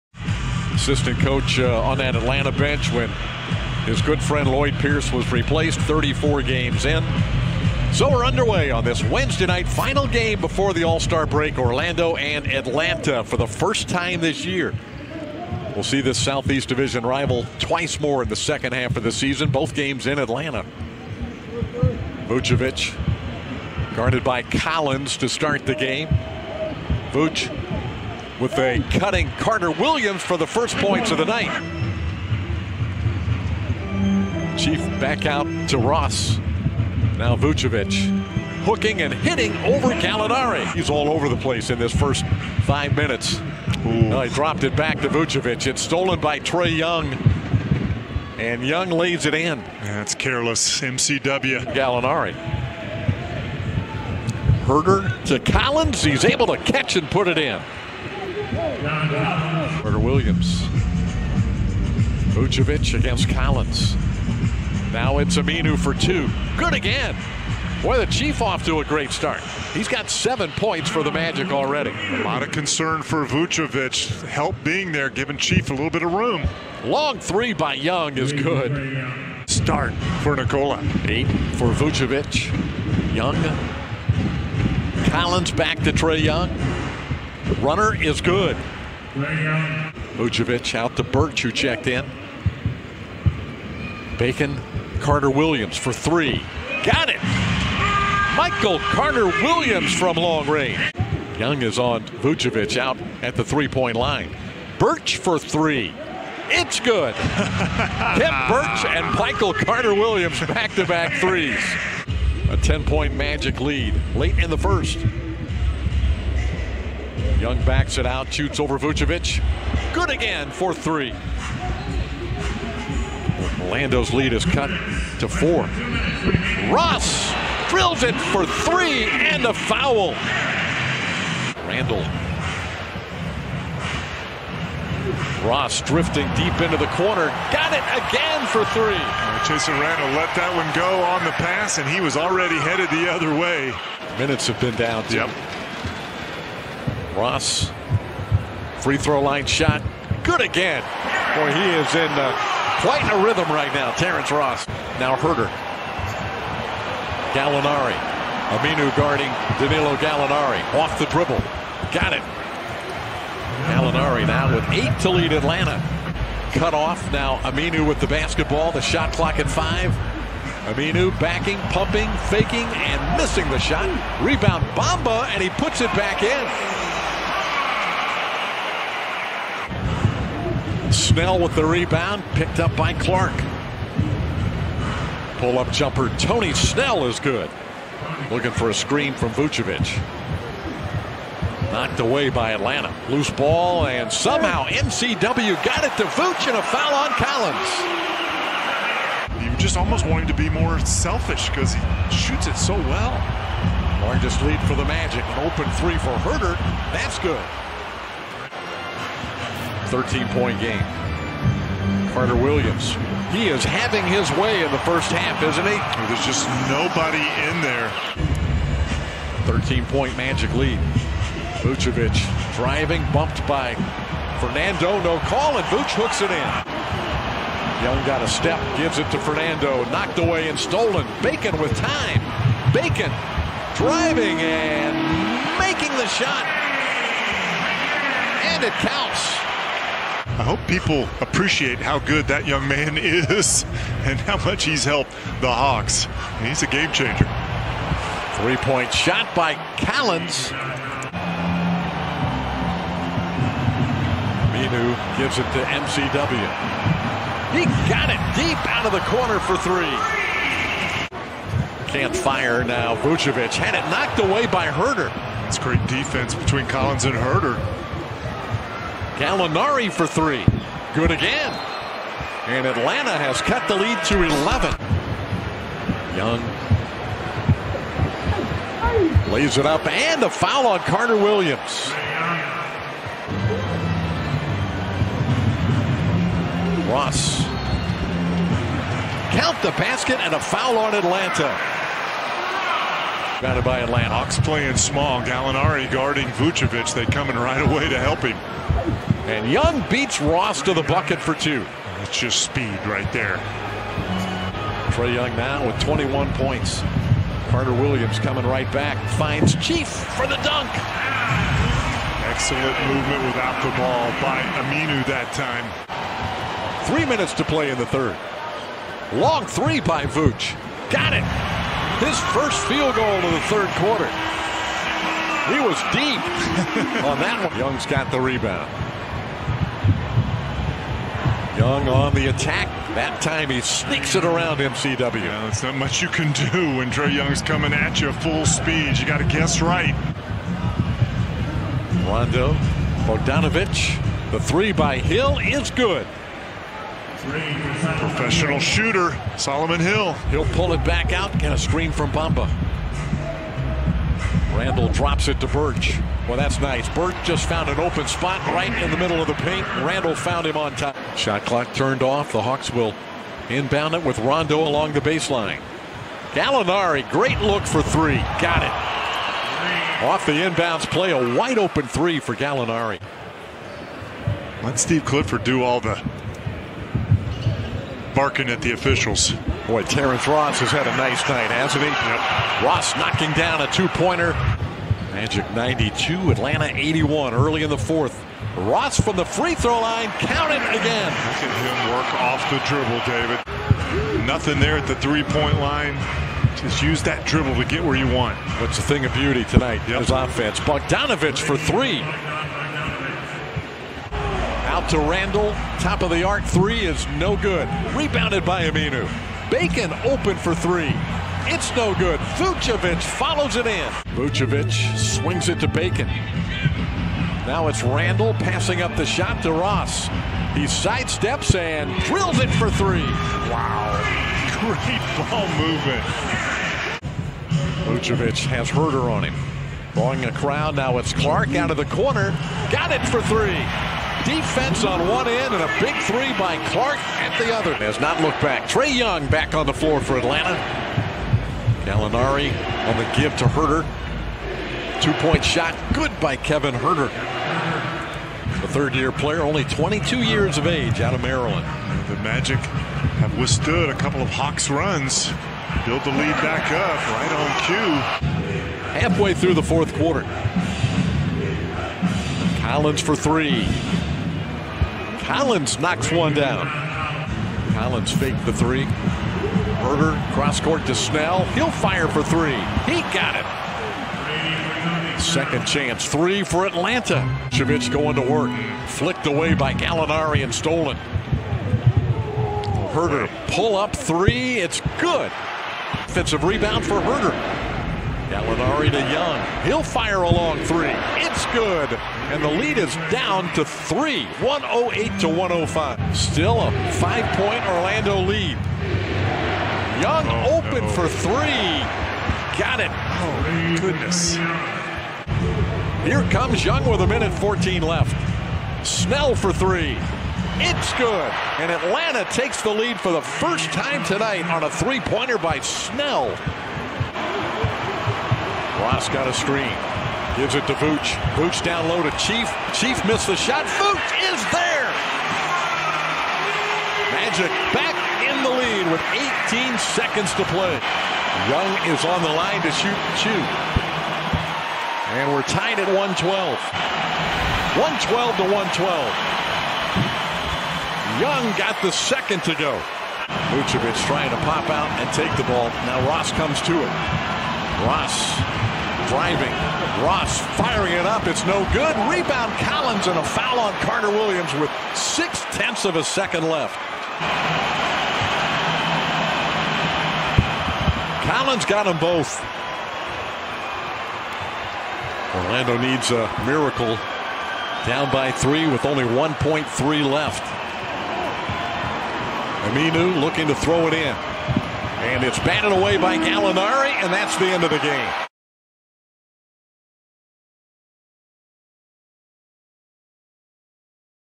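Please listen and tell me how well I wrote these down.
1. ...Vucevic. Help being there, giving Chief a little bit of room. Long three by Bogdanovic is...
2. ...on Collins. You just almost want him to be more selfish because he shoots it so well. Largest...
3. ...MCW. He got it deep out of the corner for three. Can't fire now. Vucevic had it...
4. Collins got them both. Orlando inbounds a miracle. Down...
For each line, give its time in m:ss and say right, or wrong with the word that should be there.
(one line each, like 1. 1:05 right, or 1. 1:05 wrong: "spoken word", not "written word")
1. 1:13 wrong: "Young", not "Bogdanovic"
2. 3:16 right
3. 4:15 right
4. 9:21 wrong: "needs", not "inbounds".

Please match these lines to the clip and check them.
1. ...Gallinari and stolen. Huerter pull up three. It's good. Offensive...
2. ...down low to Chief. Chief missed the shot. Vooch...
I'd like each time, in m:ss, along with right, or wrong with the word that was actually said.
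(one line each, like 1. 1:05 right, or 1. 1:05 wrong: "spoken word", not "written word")
1. 7:59 right
2. 8:41 right.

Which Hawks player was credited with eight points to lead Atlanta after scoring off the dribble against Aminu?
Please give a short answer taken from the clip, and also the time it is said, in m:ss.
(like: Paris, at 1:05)
Danilo Gallinari, at 2:43.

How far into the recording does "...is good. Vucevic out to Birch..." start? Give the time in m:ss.
1:28.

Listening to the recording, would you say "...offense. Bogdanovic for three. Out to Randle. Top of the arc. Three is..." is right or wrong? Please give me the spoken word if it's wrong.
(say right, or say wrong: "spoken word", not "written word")
right.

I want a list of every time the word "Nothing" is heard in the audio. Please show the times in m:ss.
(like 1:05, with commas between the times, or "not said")
6:34.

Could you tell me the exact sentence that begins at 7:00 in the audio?
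He sidesteps and drills it for three.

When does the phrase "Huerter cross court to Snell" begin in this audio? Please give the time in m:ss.
7:49.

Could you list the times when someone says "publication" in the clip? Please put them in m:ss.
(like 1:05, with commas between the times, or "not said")
not said.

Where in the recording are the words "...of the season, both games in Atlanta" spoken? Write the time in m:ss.
0:18.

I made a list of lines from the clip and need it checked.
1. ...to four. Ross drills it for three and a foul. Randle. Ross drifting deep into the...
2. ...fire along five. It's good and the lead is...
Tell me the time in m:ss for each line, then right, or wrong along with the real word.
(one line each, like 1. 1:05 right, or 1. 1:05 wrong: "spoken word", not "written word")
1. 2:04 right
2. 8:09 wrong: "three", not "five".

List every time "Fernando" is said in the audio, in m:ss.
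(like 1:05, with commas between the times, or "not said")
3:44, 3:49.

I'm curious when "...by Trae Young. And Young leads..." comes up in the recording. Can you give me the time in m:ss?
0:46.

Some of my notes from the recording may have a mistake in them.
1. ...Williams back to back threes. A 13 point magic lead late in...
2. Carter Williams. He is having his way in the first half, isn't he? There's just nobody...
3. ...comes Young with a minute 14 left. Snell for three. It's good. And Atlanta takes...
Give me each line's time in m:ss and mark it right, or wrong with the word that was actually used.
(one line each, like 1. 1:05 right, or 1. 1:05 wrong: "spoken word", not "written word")
1. 1:49 wrong: "10", not "13"
2. 3:32 right
3. 8:26 right.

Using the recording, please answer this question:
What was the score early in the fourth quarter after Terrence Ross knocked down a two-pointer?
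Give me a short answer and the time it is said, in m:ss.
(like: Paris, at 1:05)
Magic 92, Atlanta 81, at 6:25.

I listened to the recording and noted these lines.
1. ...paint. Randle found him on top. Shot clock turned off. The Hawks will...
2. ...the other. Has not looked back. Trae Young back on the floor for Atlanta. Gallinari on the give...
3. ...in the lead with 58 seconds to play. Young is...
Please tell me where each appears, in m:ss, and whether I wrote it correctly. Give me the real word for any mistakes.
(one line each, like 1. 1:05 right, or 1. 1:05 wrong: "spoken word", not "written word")
1. 5:59 right
2. 7:17 right
3. 8:48 wrong: "18", not "58".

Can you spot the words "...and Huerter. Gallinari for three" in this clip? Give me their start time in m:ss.
4:27.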